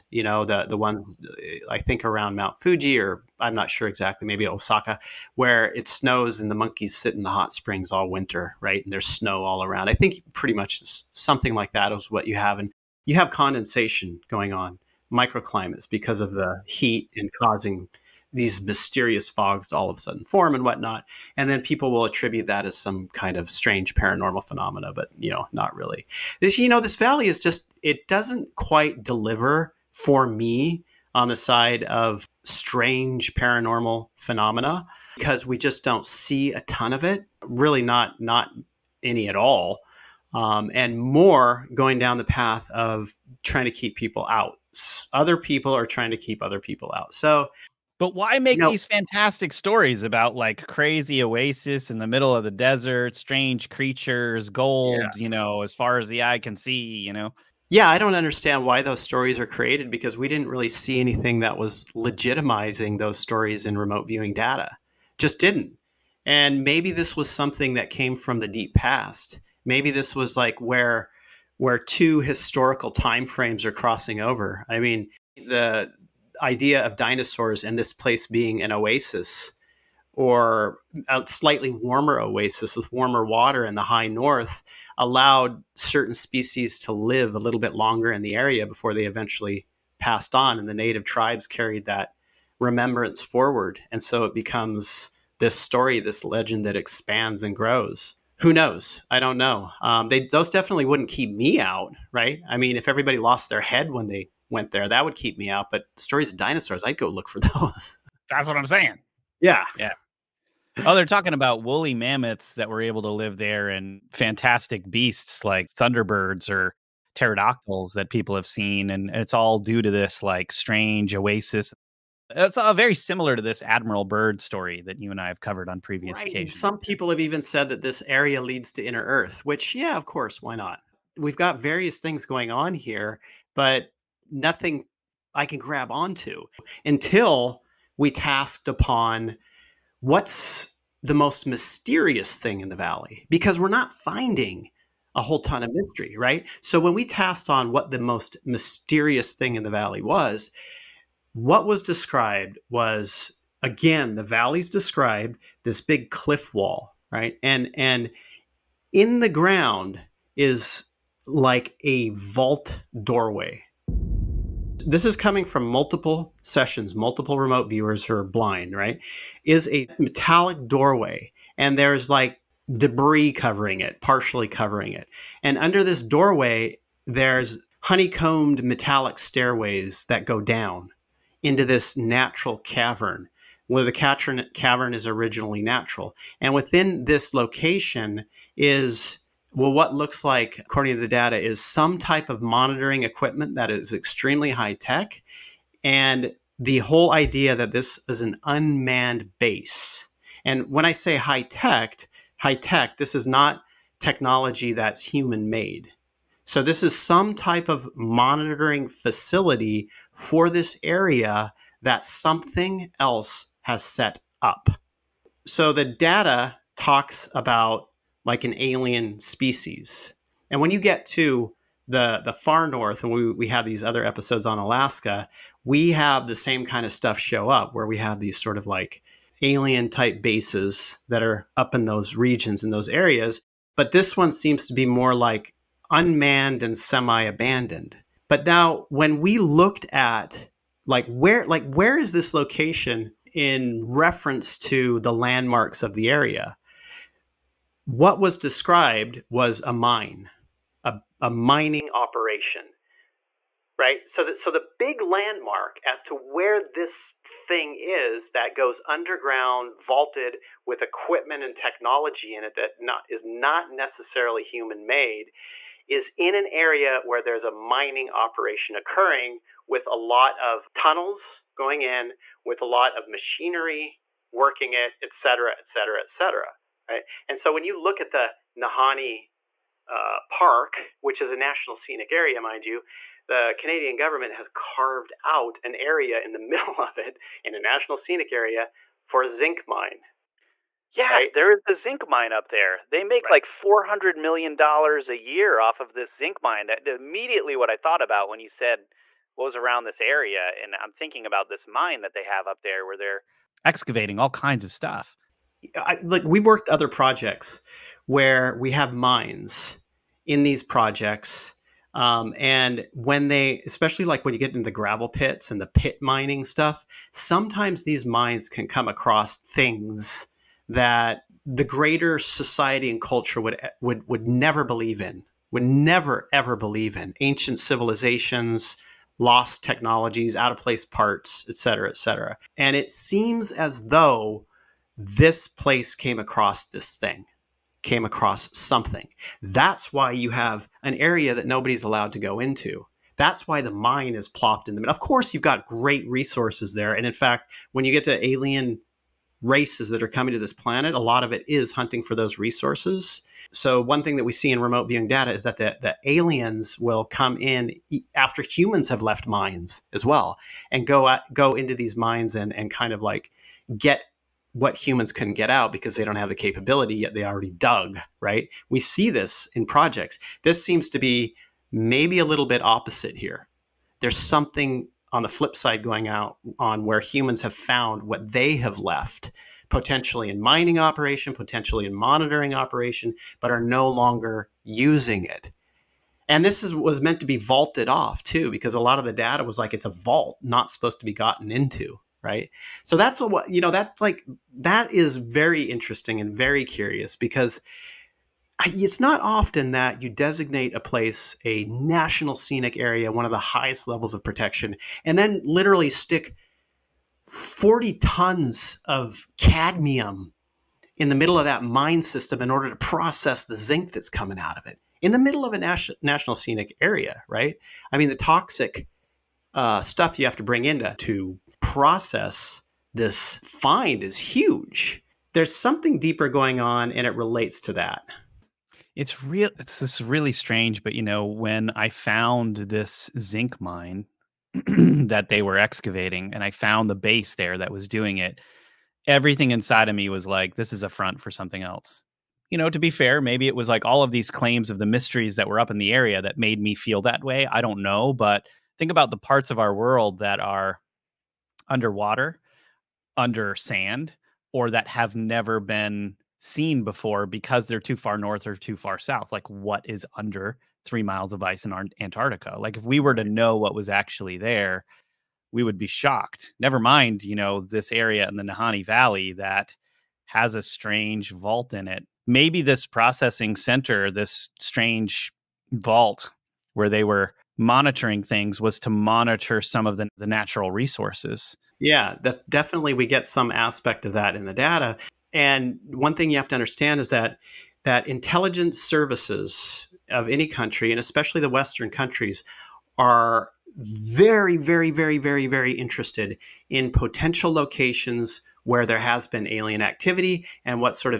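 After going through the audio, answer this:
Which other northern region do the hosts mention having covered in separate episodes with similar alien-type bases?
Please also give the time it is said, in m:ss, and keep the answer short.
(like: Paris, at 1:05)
Alaska, at 3:44.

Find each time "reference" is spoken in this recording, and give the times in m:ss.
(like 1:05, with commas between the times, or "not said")
4:03.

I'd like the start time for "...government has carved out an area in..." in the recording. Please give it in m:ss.
4:43.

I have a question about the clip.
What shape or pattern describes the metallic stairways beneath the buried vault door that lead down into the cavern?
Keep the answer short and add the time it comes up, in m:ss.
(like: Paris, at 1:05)
Honeycombed, at 2:57.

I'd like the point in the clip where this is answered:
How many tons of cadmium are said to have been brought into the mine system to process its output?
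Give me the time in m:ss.
6:47.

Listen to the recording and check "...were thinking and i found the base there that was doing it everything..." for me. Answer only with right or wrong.
wrong.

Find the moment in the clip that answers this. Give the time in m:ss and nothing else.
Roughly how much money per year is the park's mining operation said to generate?
4:53.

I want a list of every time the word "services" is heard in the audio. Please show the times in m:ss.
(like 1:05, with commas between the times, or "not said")
8:08.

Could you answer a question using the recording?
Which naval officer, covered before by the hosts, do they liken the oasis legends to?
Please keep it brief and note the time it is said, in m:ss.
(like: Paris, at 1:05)
Admiral Byrd, at 2:03.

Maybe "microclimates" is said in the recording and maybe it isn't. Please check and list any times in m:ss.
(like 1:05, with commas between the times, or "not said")
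0:15.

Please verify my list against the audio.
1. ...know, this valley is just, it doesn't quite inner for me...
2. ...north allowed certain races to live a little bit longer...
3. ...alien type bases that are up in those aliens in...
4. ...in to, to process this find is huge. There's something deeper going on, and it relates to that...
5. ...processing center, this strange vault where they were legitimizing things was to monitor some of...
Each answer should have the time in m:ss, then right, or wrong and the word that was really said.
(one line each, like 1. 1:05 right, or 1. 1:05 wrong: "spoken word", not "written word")
1. 0:26 wrong: "deliver", not "inner"
2. 1:24 wrong: "species", not "races"
3. 3:49 wrong: "regions", not "aliens"
4. 7:00 right
5. 7:52 wrong: "monitoring", not "legitimizing".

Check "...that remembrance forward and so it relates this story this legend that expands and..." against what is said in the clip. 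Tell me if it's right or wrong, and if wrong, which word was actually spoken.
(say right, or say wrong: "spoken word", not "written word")
wrong: "becomes", not "relates".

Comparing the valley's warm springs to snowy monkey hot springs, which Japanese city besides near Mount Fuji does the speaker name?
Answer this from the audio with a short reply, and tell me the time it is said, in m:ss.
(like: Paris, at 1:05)
Osaka, at 0:04.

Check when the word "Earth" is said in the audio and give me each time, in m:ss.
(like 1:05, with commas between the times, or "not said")
2:09.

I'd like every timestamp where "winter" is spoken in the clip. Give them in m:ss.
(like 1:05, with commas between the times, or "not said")
0:08.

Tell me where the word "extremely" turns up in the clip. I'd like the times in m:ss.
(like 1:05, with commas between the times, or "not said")
3:13.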